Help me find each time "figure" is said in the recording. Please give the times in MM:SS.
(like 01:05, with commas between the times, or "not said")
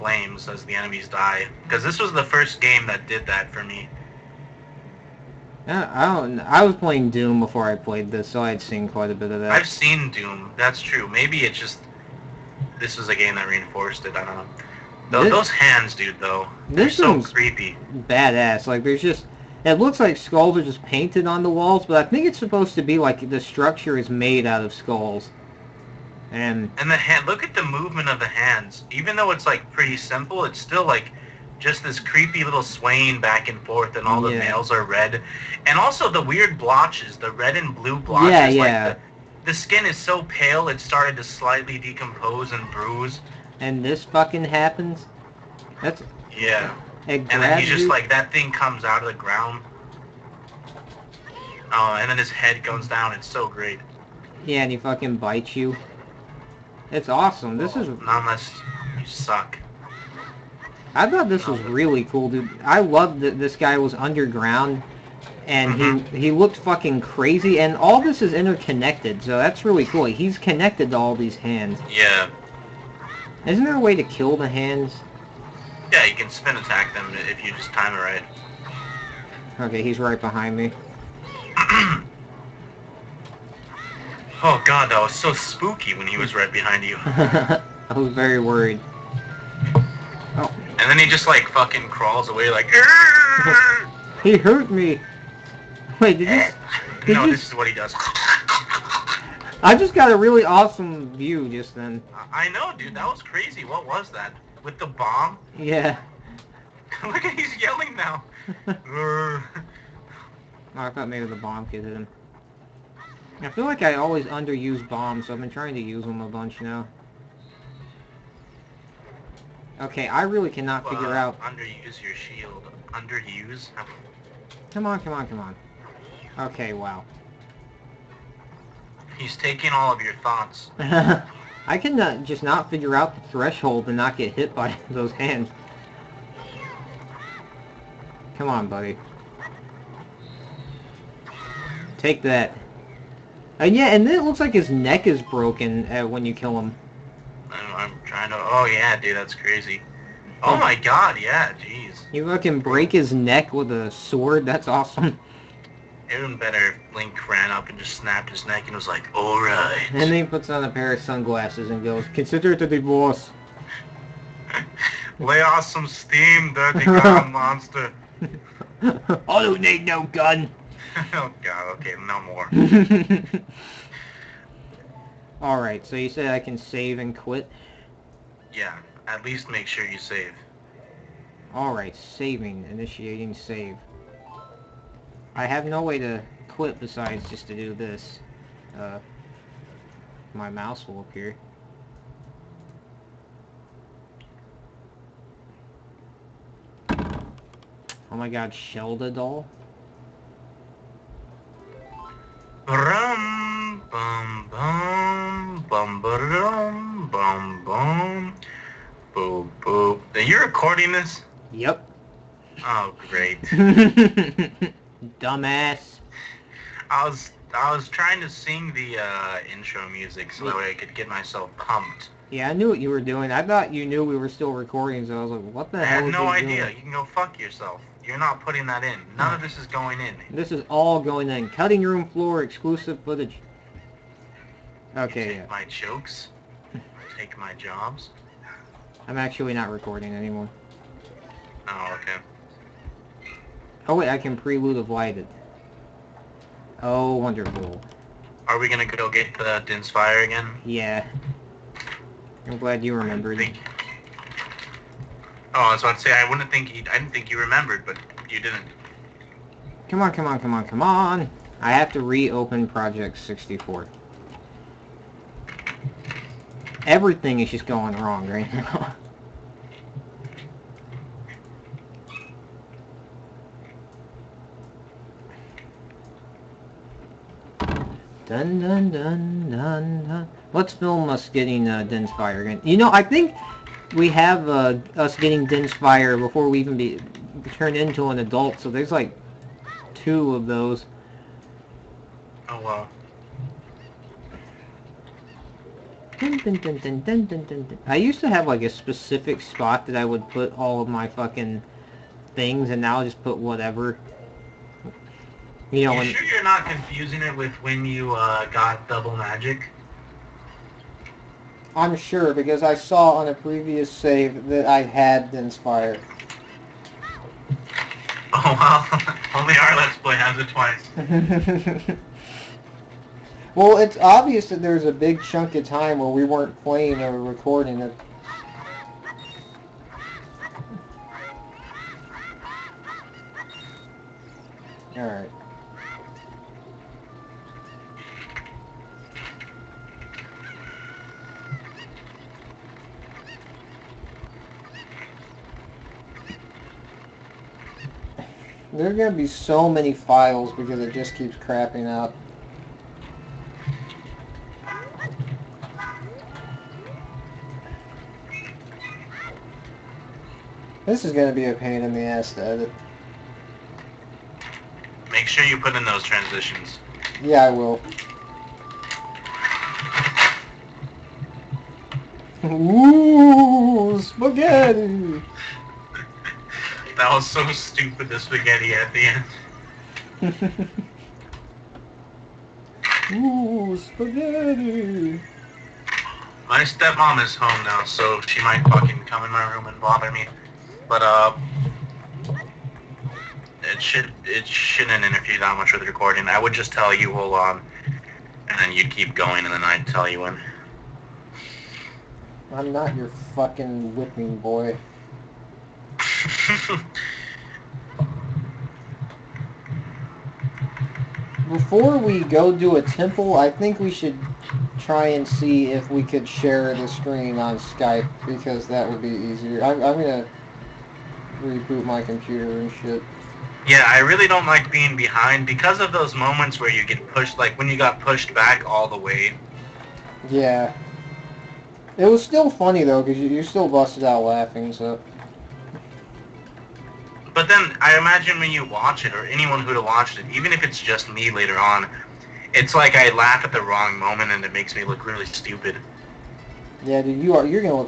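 02:00, 02:12.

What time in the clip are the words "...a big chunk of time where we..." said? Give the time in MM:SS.
05:24.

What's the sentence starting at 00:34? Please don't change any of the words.
nails are red, and also the weird blotches, the red and blue blotches.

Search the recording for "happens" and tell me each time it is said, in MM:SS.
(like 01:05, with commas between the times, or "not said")
00:44.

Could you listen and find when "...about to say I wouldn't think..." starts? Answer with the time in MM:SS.
04:15.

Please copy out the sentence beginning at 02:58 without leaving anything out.
Yeah, at least make sure you save.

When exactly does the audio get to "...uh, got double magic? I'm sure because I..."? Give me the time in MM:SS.
05:08.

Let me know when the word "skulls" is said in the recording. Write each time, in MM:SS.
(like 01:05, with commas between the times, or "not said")
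00:20, 00:24.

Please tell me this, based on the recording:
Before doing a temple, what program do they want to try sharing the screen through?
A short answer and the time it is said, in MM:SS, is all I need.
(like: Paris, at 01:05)
Skype, at 06:57.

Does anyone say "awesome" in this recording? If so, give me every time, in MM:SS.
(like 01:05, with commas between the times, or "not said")
00:57, 01:40, 02:34.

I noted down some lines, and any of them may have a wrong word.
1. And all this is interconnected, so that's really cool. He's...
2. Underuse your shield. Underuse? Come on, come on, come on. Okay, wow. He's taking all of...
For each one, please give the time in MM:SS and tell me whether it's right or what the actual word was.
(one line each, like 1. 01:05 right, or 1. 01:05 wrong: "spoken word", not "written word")
1. 01:07 right
2. 02:01 right.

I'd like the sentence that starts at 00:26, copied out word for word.
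And and the hand, look at the movement of the hands.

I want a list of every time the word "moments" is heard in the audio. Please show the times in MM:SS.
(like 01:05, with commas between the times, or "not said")
07:06, 07:23.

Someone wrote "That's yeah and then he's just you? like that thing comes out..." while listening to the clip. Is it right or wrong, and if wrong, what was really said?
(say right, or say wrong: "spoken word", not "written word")
right.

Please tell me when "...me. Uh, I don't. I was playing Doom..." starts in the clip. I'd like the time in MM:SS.
00:03.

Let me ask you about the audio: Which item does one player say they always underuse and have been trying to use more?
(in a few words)
Bombs.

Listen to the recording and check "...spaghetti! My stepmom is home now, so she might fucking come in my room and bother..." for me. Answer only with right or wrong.
right.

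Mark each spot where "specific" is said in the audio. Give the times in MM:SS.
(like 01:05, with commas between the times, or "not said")
04:58.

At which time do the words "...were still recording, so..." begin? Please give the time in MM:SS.
03:44.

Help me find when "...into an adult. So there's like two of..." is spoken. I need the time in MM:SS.
04:47.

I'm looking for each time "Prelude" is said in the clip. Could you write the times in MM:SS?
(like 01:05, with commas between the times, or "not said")
04:04.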